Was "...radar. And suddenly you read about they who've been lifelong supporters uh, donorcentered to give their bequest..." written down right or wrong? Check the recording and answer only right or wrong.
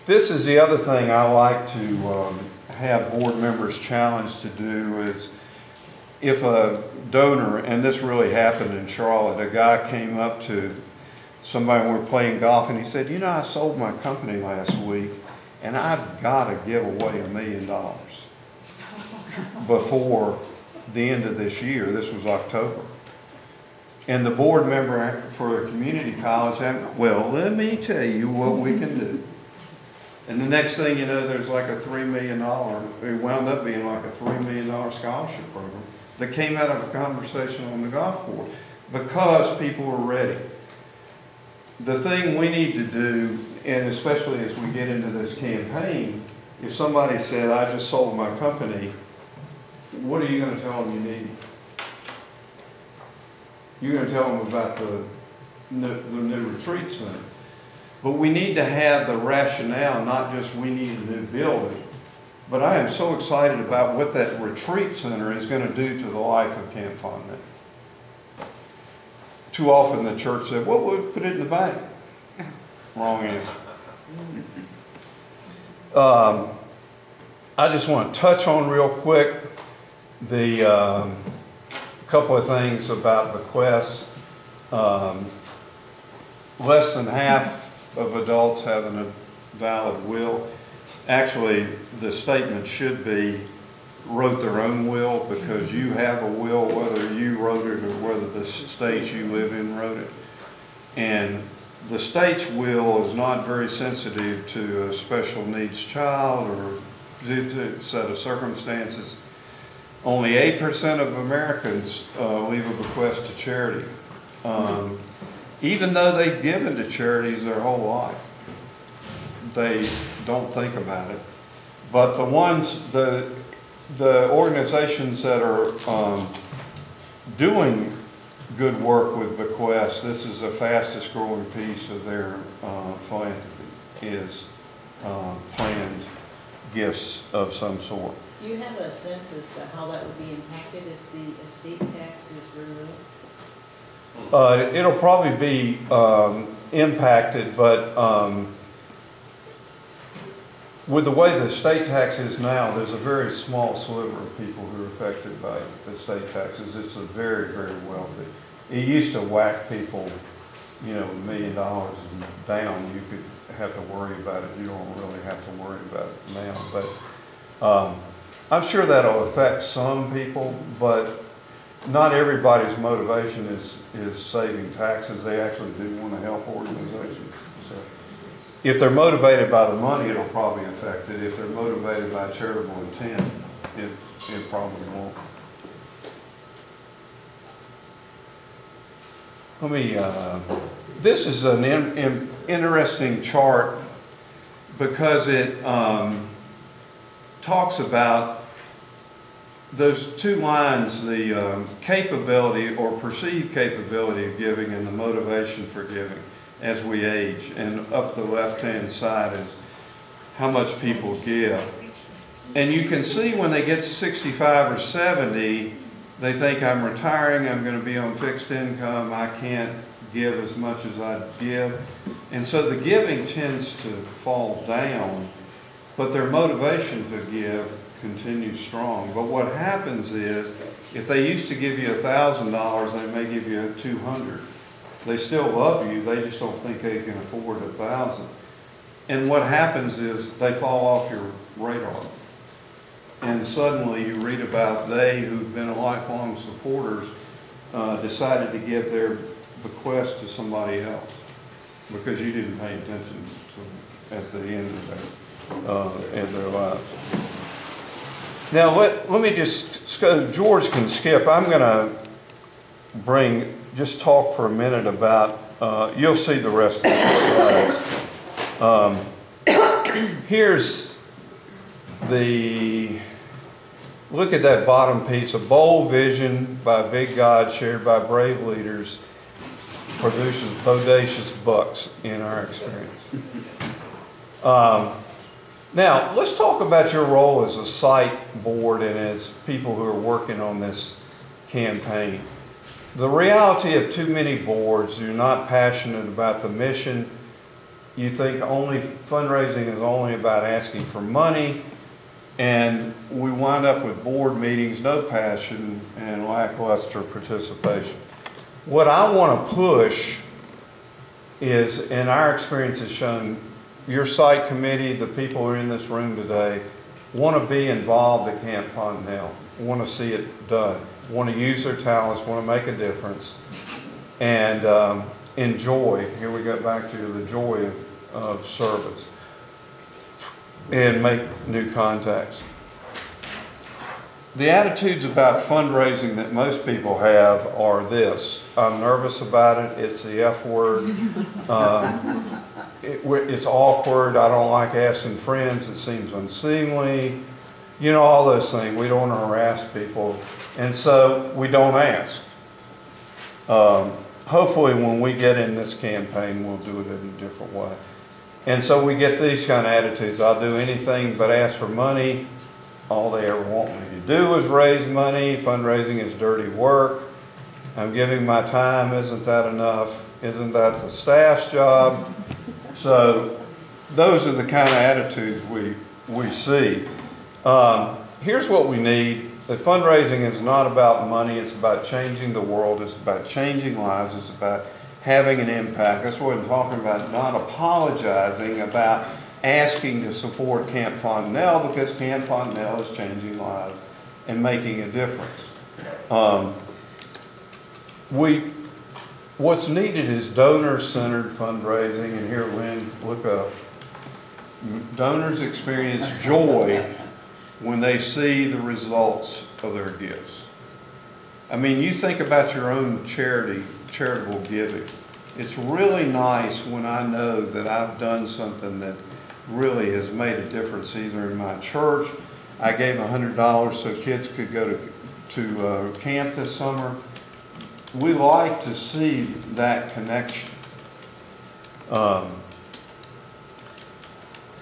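wrong.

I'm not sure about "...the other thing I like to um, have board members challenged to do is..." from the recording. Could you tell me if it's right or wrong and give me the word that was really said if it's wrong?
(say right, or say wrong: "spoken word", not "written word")
right.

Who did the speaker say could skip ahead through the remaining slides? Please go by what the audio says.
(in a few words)
George.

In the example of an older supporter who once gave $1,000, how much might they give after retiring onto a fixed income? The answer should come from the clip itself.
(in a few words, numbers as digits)
200.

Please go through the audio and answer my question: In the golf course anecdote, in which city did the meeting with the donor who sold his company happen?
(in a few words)
Charlotte.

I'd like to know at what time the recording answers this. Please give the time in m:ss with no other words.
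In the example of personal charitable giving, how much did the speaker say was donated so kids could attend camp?
7:02.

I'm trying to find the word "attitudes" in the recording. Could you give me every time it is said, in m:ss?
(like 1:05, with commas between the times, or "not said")
5:34, 5:59, 6:14.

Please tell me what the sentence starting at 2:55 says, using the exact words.
They actually do want to help organizations.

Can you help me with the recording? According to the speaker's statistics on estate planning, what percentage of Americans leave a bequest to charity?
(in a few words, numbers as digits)
8%.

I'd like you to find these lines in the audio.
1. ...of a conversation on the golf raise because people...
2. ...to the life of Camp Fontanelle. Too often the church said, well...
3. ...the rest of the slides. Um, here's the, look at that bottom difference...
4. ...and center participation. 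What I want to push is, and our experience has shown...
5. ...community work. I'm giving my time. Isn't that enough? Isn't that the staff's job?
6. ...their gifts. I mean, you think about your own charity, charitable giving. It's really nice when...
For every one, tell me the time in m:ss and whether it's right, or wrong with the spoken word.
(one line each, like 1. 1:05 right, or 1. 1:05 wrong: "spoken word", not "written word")
1. 0:36 wrong: "course", not "raise"
2. 1:05 right
3. 4:26 wrong: "piece", not "difference"
4. 5:05 wrong: "lackluster", not "center"
5. 6:06 wrong: "dirty", not "community"
6. 6:49 right.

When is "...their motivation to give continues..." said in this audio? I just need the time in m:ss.
3:46.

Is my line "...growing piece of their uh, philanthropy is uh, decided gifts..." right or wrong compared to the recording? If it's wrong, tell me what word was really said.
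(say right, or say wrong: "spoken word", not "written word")
wrong: "planned", not "decided".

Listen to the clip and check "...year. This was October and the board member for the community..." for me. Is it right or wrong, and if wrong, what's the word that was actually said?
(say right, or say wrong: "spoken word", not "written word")
right.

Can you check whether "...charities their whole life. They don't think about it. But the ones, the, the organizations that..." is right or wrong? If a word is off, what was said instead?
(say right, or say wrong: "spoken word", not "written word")
right.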